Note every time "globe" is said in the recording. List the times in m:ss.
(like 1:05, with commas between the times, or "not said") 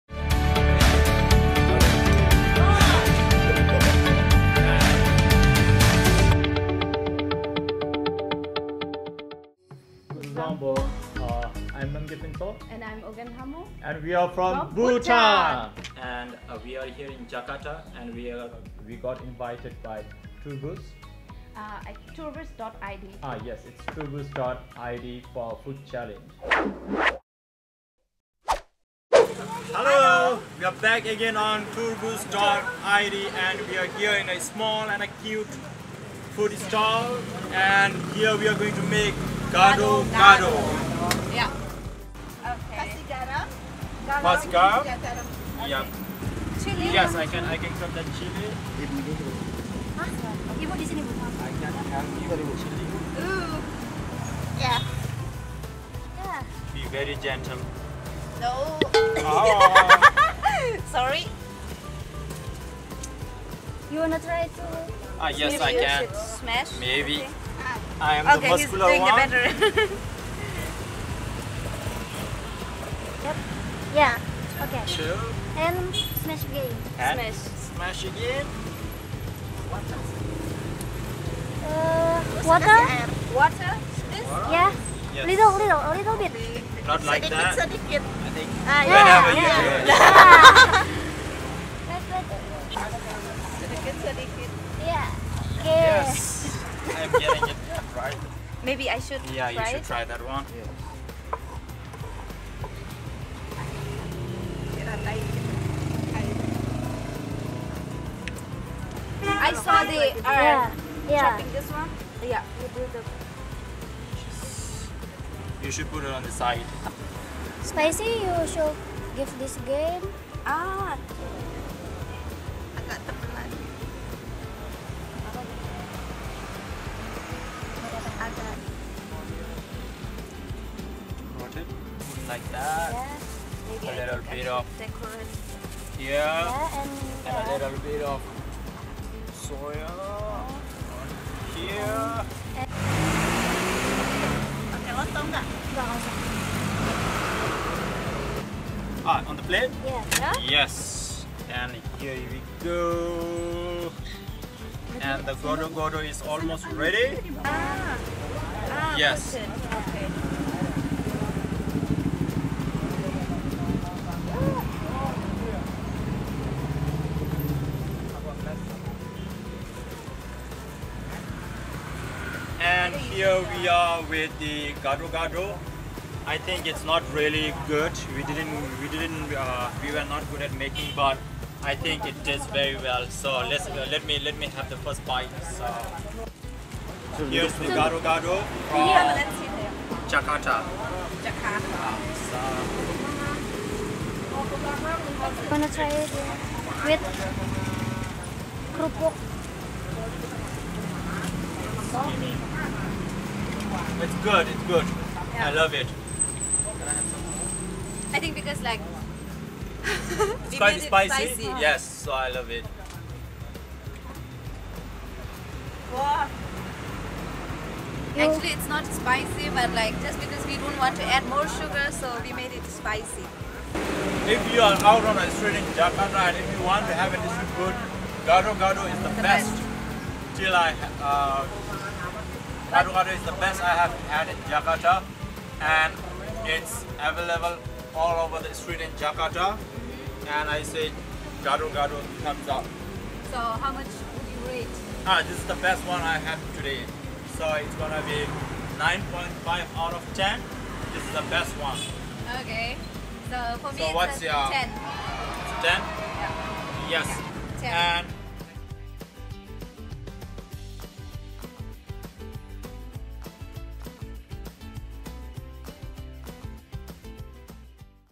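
not said.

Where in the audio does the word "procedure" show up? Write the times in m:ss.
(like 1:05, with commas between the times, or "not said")
not said.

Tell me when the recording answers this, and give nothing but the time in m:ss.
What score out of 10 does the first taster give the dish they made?
4:08.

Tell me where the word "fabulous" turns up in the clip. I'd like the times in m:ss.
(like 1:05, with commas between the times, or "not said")
not said.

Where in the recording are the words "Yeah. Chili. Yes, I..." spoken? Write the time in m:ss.
0:45.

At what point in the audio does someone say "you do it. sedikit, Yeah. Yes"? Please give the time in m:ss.
1:32.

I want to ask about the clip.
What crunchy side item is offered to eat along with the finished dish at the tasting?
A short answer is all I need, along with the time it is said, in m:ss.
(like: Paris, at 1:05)
kerupuk, at 3:18.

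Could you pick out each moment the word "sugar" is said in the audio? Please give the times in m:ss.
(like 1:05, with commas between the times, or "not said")
3:41.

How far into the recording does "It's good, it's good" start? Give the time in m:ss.
3:24.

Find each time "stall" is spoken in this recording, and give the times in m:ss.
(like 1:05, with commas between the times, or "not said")
0:36.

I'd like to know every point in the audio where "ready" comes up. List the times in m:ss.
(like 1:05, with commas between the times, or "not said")
2:36.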